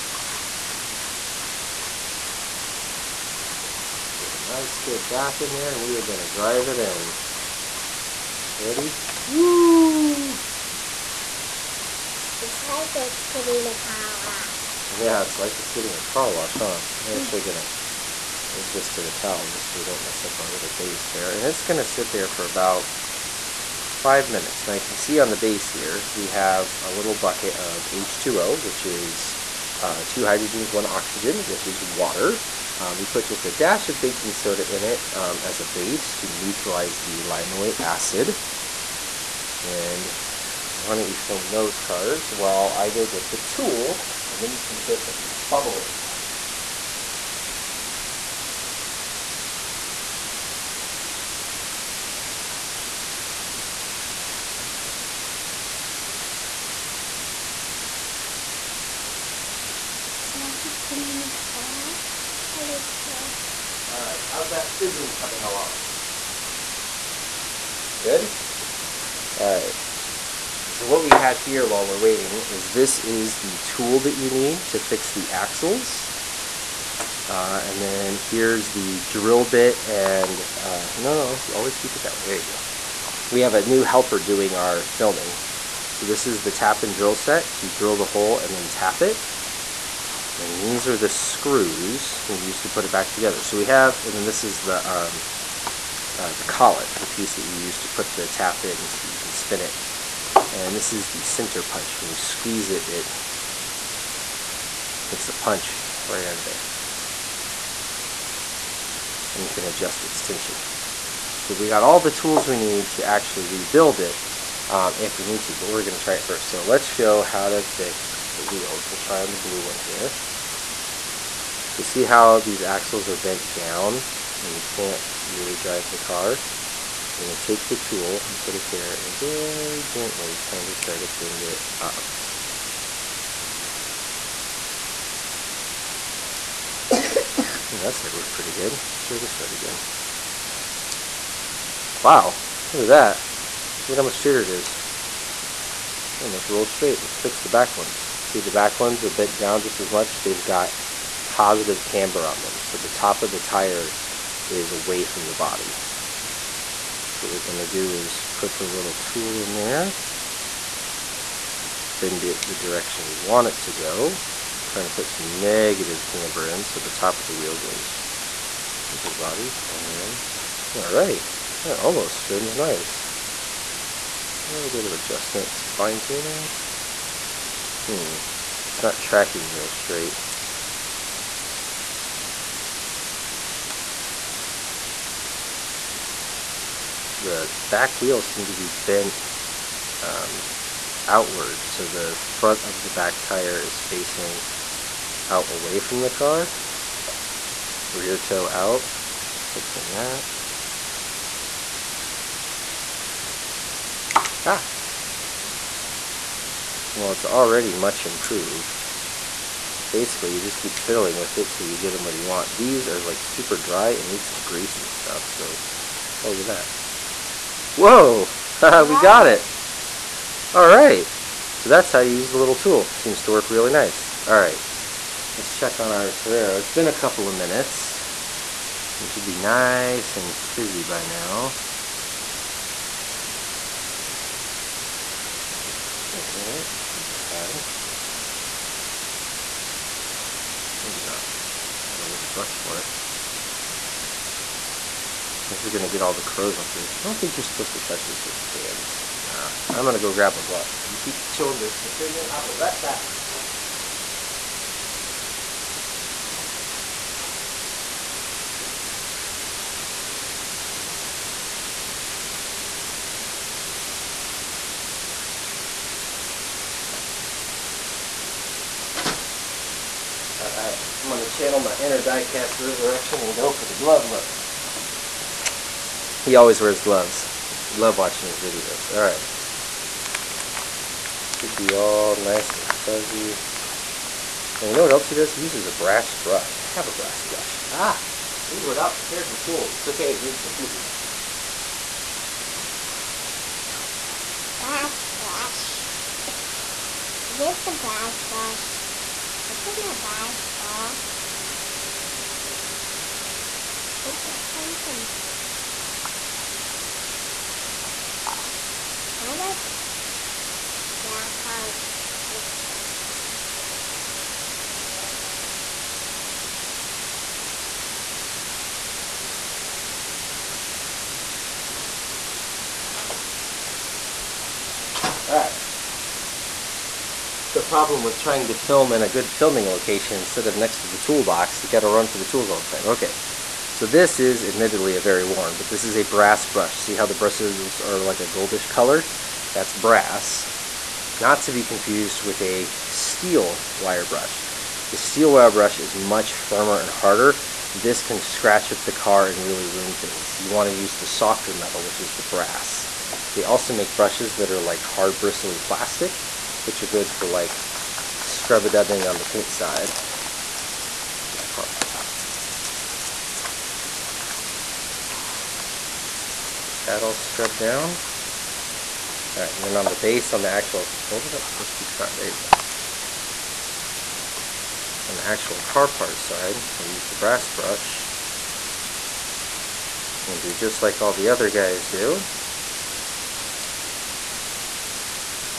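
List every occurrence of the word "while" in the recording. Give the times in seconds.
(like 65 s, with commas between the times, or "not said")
42 s, 71 s.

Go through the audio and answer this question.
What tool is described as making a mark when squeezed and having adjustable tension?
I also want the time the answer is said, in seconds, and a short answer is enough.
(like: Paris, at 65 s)
center punch, at 101 s.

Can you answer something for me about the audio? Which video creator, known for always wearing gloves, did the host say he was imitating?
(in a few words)
Diecast Resurrection.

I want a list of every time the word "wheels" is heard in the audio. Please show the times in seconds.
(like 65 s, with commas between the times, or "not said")
118 s, 167 s, 188 s.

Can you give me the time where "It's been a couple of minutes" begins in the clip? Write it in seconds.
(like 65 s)
226 s.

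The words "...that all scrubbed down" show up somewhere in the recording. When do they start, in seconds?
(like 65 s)
366 s.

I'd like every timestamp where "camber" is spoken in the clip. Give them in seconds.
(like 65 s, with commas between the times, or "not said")
151 s, 166 s.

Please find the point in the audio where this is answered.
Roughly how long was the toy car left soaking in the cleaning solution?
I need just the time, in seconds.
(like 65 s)
23 s.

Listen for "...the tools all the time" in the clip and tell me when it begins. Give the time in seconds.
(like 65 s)
332 s.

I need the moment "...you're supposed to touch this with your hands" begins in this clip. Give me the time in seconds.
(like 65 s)
247 s.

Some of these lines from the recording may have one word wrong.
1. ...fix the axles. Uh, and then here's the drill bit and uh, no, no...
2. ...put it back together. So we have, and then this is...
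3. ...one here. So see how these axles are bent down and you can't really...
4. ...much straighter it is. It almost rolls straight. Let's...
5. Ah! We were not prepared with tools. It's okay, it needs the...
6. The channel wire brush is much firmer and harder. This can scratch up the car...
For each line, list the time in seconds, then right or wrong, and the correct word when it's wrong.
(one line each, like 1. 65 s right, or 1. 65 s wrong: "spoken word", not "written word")
1. 74 s right
2. 92 s right
3. 119 s right
4. 144 s right
5. 287 s right
6. 344 s wrong: "steel", not "channel".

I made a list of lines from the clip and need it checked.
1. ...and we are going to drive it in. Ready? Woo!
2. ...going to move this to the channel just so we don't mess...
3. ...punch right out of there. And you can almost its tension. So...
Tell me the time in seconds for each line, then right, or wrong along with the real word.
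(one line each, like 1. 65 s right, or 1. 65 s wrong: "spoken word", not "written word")
1. 5 s right
2. 17 s wrong: "towel", not "channel"
3. 105 s wrong: "adjust", not "almost".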